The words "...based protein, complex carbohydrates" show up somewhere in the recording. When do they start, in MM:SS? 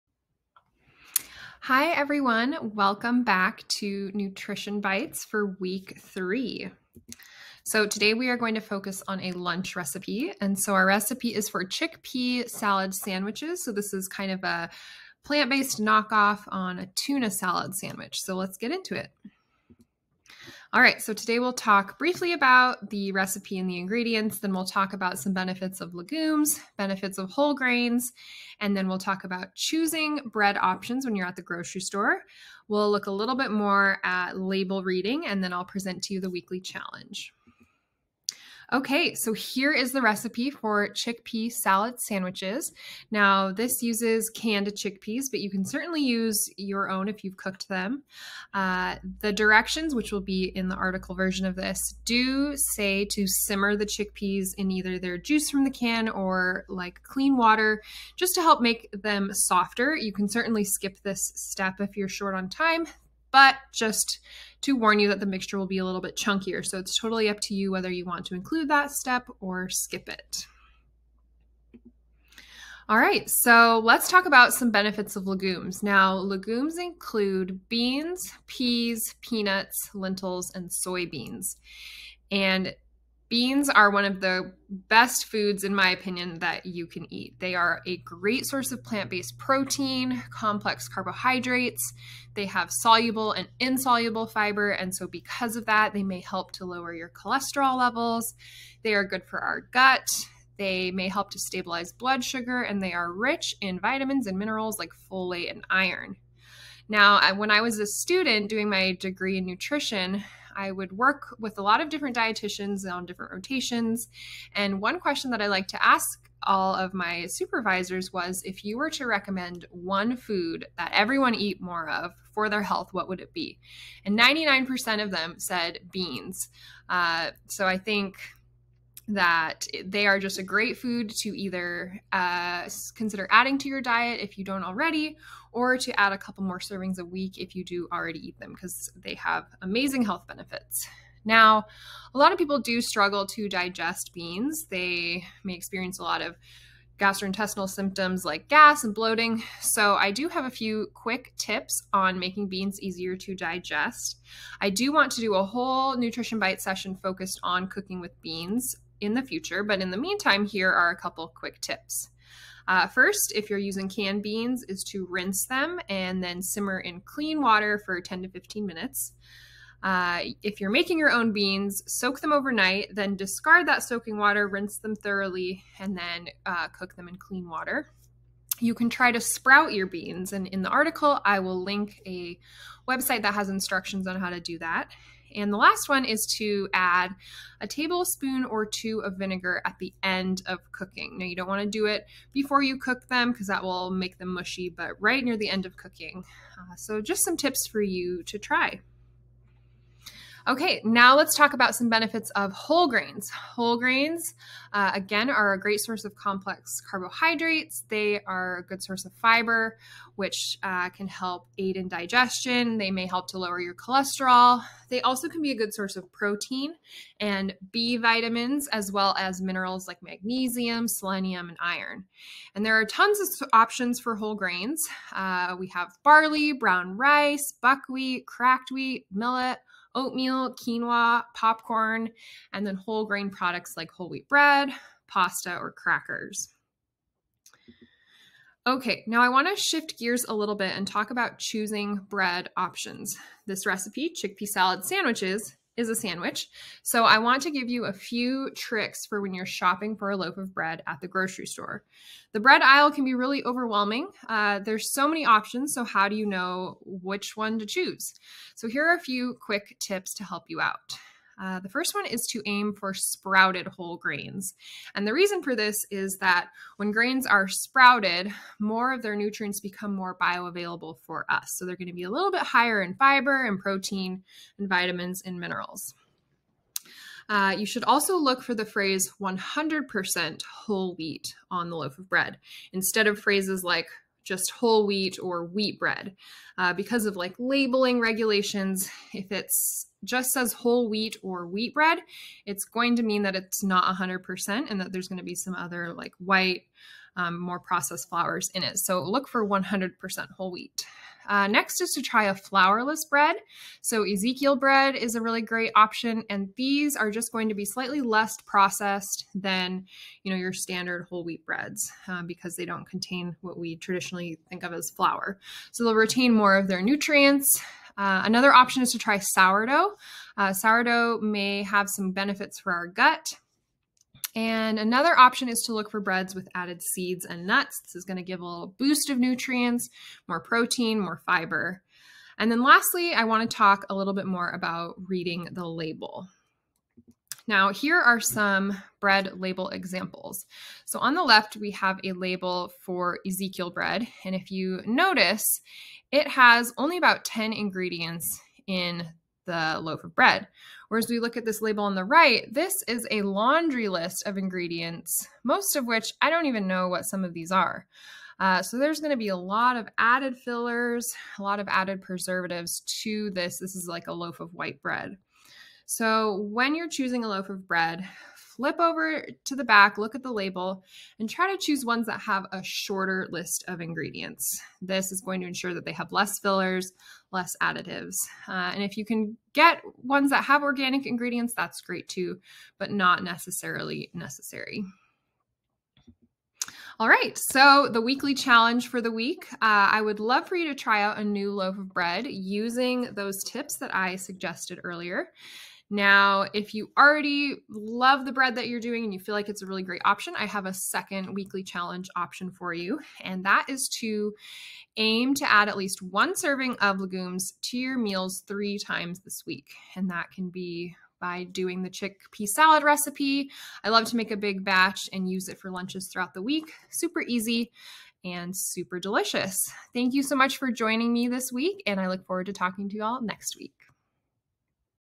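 01:29.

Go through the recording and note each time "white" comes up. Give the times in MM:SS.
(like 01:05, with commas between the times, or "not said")
04:56, 06:04.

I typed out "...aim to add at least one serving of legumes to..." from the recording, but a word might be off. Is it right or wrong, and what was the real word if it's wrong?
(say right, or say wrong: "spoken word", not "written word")
right.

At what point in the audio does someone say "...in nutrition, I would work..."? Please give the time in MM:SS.
01:49.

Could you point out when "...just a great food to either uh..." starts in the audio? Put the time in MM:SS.
02:10.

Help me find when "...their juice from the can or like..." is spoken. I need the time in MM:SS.
00:54.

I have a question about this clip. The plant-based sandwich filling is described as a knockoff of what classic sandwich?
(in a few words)
tuna salad.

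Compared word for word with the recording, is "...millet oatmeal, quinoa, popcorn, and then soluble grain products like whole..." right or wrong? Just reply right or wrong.
wrong.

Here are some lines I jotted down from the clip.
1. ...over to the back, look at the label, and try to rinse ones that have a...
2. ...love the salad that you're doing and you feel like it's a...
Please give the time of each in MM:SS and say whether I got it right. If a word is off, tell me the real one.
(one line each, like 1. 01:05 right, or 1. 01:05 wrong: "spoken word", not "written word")
1. 06:08 wrong: "choose", not "rinse"
2. 06:37 wrong: "bread", not "salad".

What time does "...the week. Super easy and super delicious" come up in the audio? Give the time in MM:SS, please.
06:56.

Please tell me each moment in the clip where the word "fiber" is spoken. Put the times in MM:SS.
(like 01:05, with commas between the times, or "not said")
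01:34, 03:29, 04:32, 05:31.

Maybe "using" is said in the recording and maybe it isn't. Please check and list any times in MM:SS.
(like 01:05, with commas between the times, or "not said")
02:43, 06:32.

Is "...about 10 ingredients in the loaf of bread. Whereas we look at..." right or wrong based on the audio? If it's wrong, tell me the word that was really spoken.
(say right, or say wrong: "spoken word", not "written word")
right.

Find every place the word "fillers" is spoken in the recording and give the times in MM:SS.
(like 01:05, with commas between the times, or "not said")
06:00, 06:16.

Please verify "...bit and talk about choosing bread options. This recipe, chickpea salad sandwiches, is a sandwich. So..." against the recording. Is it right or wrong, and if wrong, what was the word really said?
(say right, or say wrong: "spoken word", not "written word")
right.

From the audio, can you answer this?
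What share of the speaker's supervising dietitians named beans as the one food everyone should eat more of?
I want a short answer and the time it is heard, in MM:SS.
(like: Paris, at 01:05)
99%, at 02:04.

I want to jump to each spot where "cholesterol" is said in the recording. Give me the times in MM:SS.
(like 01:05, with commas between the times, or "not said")
01:37, 03:33.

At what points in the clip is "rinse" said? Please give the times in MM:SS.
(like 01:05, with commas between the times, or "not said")
02:45, 02:54.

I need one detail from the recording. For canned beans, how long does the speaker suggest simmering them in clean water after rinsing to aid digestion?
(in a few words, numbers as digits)
10 to 15 minutes.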